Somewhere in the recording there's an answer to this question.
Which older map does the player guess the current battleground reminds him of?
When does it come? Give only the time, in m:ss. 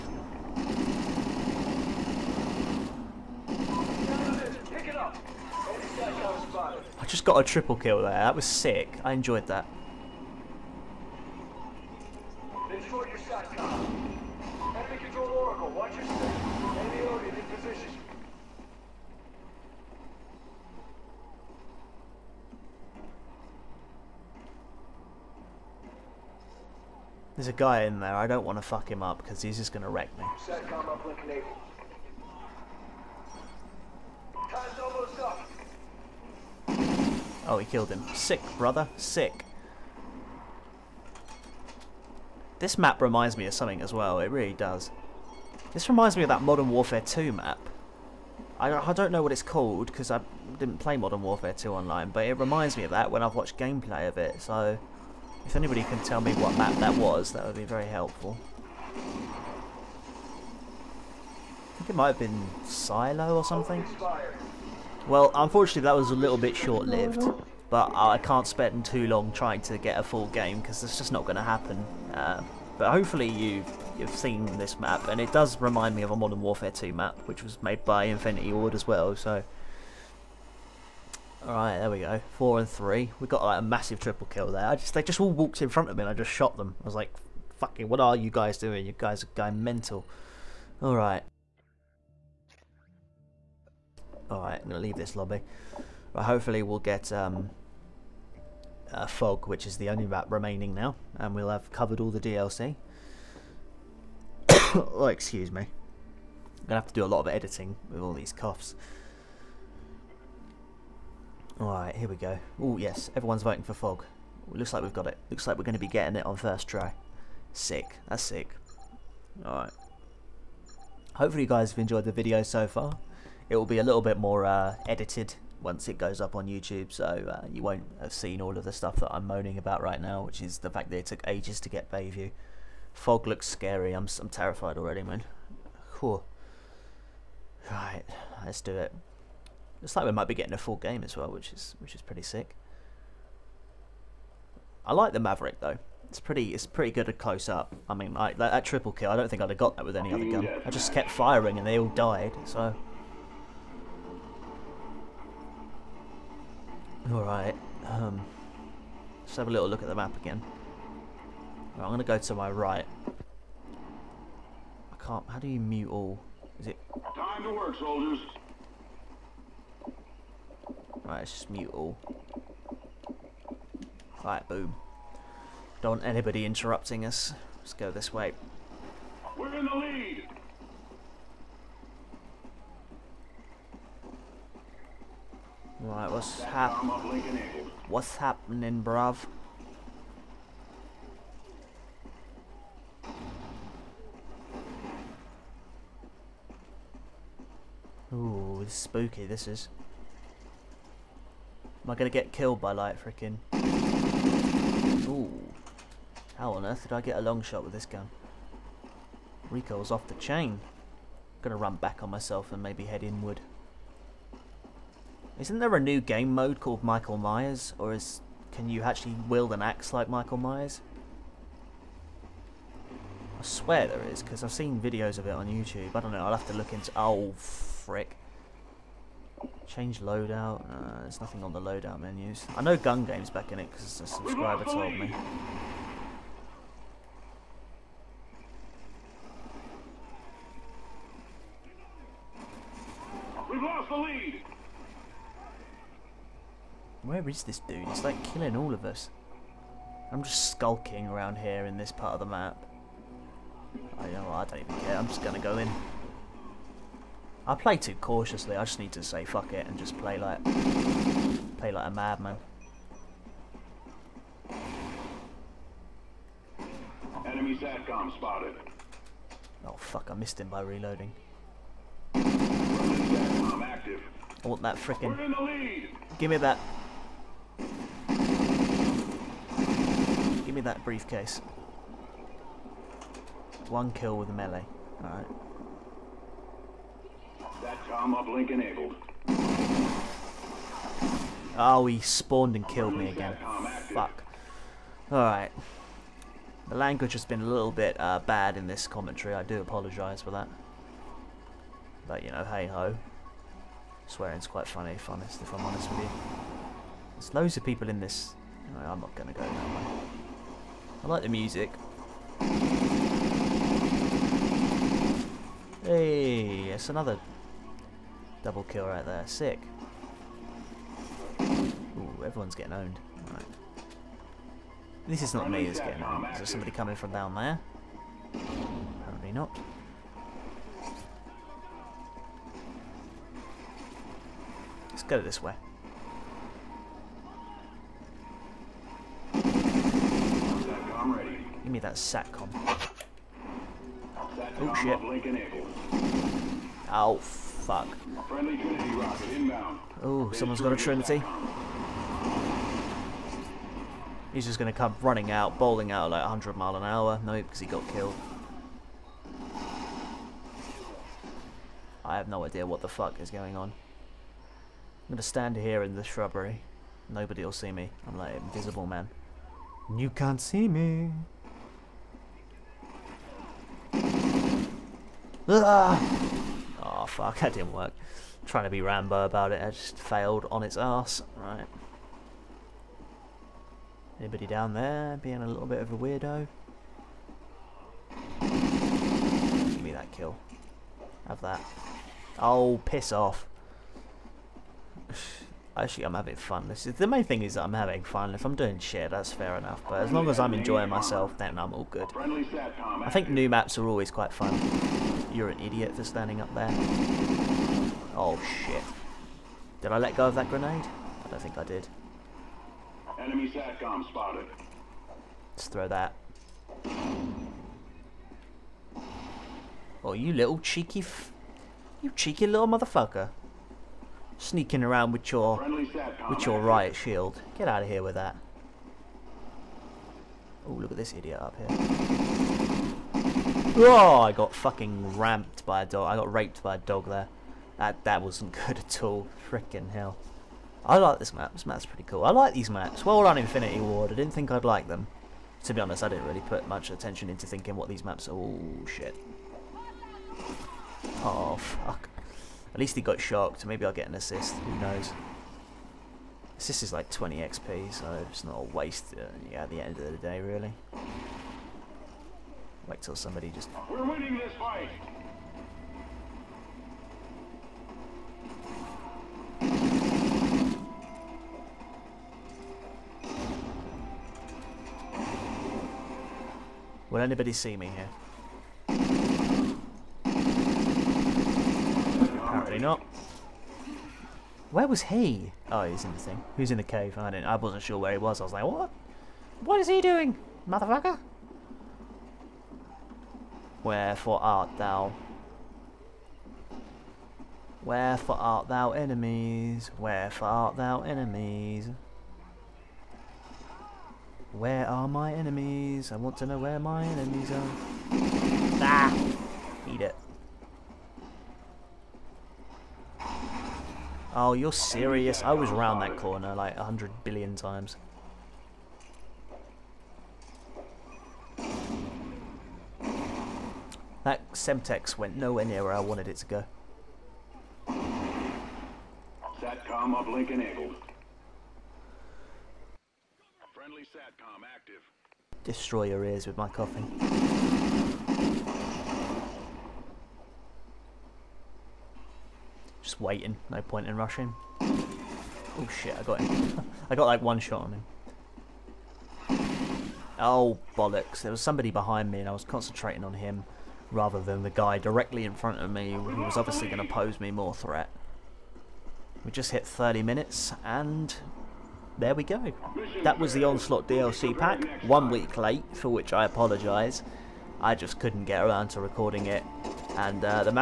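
1:02.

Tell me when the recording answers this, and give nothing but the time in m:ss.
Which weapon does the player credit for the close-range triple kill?
2:25.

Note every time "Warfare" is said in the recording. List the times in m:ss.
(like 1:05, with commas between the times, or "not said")
0:46, 0:51, 1:16.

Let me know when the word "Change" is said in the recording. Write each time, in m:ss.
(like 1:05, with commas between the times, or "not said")
3:49.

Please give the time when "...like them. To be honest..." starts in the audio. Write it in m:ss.
7:24.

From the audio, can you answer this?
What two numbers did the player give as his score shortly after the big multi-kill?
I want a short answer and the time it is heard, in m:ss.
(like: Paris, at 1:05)
4 and 3, at 1:22.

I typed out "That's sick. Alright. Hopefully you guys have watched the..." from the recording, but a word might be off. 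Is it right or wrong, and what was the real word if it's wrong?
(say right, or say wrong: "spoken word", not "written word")
wrong: "enjoyed", not "watched".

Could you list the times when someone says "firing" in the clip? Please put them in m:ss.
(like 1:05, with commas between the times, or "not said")
2:31.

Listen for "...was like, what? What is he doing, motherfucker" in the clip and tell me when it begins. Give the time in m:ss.
8:08.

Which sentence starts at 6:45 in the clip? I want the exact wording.
You're an idiot for standing up there.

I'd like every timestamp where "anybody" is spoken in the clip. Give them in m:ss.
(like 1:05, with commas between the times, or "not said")
0:55, 2:56, 6:24, 7:57.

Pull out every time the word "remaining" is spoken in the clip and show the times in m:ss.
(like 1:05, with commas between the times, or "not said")
1:40.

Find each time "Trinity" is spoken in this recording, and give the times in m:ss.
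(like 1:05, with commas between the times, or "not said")
5:50.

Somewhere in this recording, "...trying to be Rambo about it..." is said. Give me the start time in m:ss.
6:18.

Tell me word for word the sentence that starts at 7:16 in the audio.
I got raped by a dog there.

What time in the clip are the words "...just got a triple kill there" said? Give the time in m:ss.
0:07.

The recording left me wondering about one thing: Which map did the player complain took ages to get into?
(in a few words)
Bayview.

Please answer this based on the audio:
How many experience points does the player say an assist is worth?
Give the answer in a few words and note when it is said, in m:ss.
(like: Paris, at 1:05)
20, at 7:37.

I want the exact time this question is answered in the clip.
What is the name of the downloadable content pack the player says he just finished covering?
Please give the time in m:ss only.
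9:23.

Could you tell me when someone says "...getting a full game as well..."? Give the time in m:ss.
2:20.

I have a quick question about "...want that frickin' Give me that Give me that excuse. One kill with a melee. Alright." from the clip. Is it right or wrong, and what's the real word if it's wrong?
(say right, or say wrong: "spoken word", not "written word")
wrong: "briefcase", not "excuse".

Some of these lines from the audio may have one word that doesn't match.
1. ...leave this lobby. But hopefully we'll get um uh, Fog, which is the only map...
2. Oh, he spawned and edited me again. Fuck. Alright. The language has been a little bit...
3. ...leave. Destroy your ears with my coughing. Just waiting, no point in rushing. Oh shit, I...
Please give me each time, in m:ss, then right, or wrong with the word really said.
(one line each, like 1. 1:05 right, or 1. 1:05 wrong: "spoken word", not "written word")
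1. 1:34 right
2. 4:51 wrong: "killed", not "edited"
3. 8:54 wrong: "active", not "leave".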